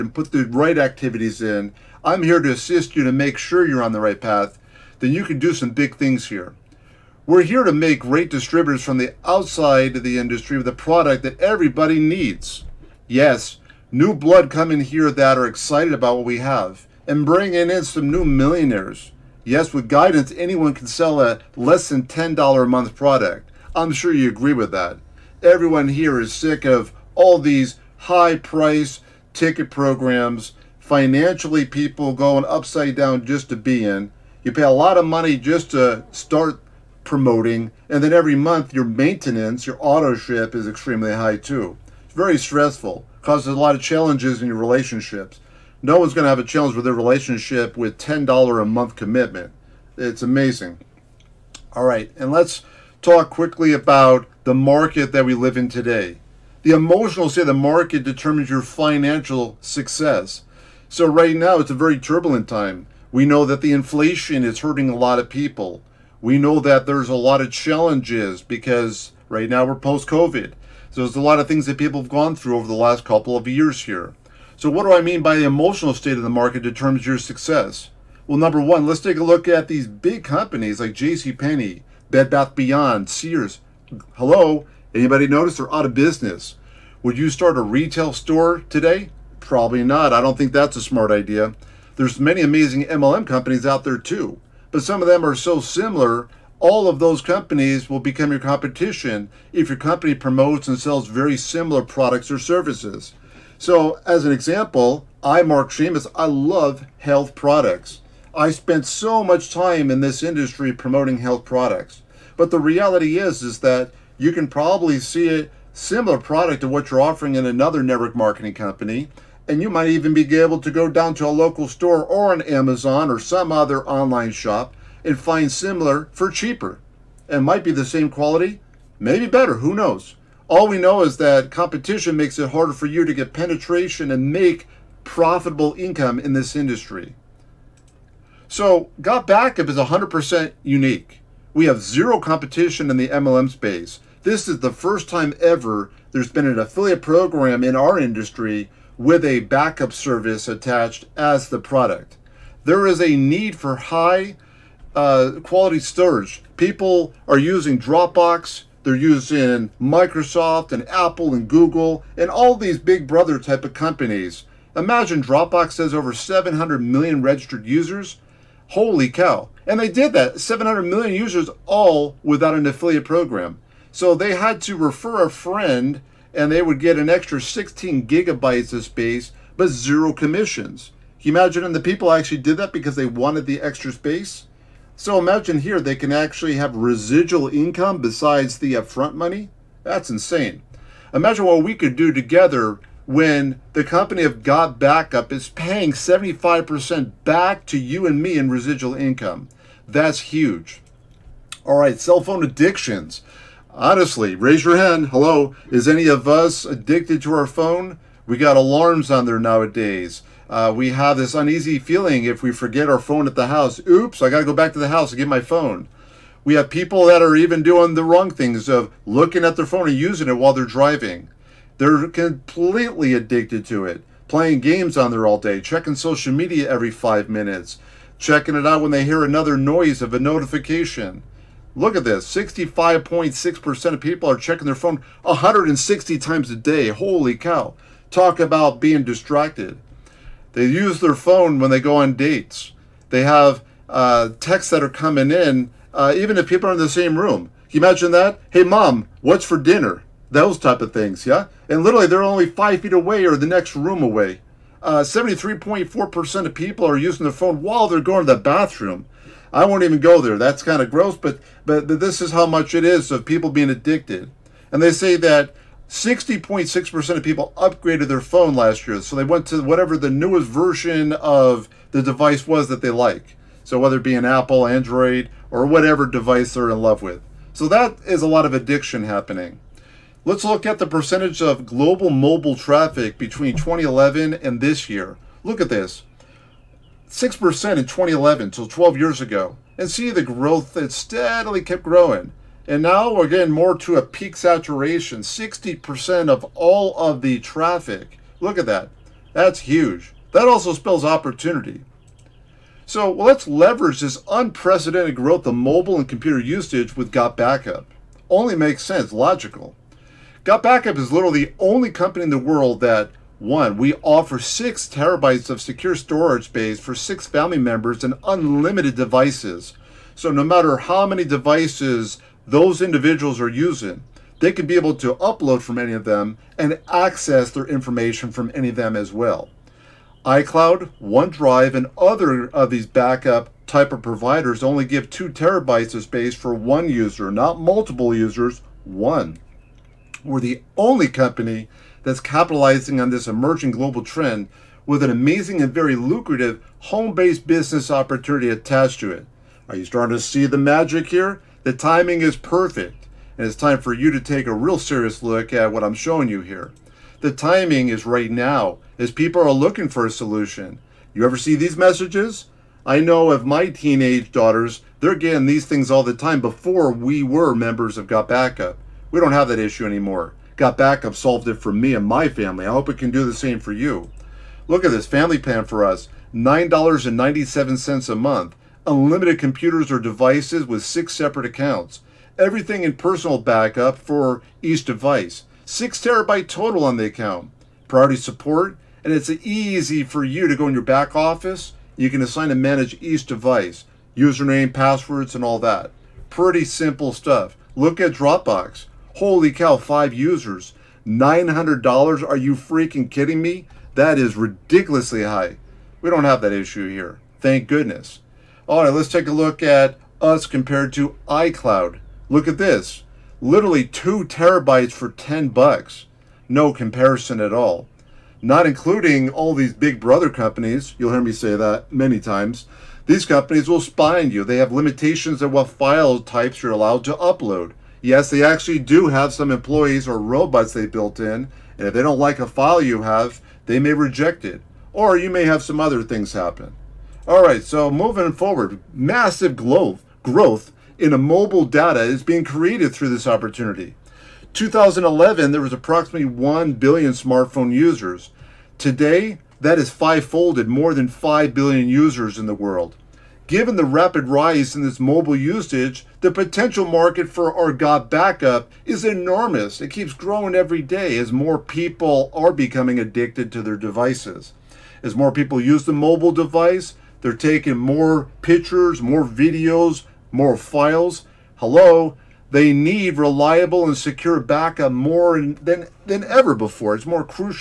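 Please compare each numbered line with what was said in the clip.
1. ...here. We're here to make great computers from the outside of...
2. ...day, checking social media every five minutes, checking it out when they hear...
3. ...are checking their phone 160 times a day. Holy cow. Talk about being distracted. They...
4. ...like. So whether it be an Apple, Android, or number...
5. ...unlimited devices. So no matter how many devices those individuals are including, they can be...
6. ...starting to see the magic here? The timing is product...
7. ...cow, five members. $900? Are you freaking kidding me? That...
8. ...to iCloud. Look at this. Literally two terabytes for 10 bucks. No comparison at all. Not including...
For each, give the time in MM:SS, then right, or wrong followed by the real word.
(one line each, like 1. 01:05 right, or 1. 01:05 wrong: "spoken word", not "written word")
1. 00:06 wrong: "distributors", not "computers"
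2. 03:45 right
3. 03:54 right
4. 04:32 wrong: "whatever", not "number"
5. 05:18 wrong: "using", not "including"
6. 05:49 wrong: "perfect", not "product"
7. 06:39 wrong: "users", not "members"
8. 06:50 right.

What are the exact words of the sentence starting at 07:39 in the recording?
It keeps growing every day as more people are becoming addicted to their devices.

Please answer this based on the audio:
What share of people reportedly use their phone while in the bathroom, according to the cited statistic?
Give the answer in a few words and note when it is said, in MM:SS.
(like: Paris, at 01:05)
73.4%, at 04:14.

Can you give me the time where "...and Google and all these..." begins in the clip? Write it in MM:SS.
02:41.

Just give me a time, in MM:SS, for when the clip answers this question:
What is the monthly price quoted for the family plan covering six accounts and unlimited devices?
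06:16.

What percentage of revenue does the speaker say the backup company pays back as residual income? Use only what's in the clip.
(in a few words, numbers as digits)
75%.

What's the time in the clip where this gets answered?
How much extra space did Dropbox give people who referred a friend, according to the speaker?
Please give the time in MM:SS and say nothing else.
02:57.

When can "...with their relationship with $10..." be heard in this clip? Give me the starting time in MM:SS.
00:46.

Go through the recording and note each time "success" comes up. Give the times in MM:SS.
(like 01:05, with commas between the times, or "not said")
00:59, 01:17.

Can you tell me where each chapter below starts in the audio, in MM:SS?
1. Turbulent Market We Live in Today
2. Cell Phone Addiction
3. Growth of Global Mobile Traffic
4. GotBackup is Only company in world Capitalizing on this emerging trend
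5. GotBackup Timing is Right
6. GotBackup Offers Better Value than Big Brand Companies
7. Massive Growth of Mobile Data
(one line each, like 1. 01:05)
1. 00:53
2. 03:20
3. 04:39
4. 05:11
5. 05:57
6. 06:13
7. 07:16.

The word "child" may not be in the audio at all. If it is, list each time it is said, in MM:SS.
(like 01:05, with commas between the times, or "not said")
not said.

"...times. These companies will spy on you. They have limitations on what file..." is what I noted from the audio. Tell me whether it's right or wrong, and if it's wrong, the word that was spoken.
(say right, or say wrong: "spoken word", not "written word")
right.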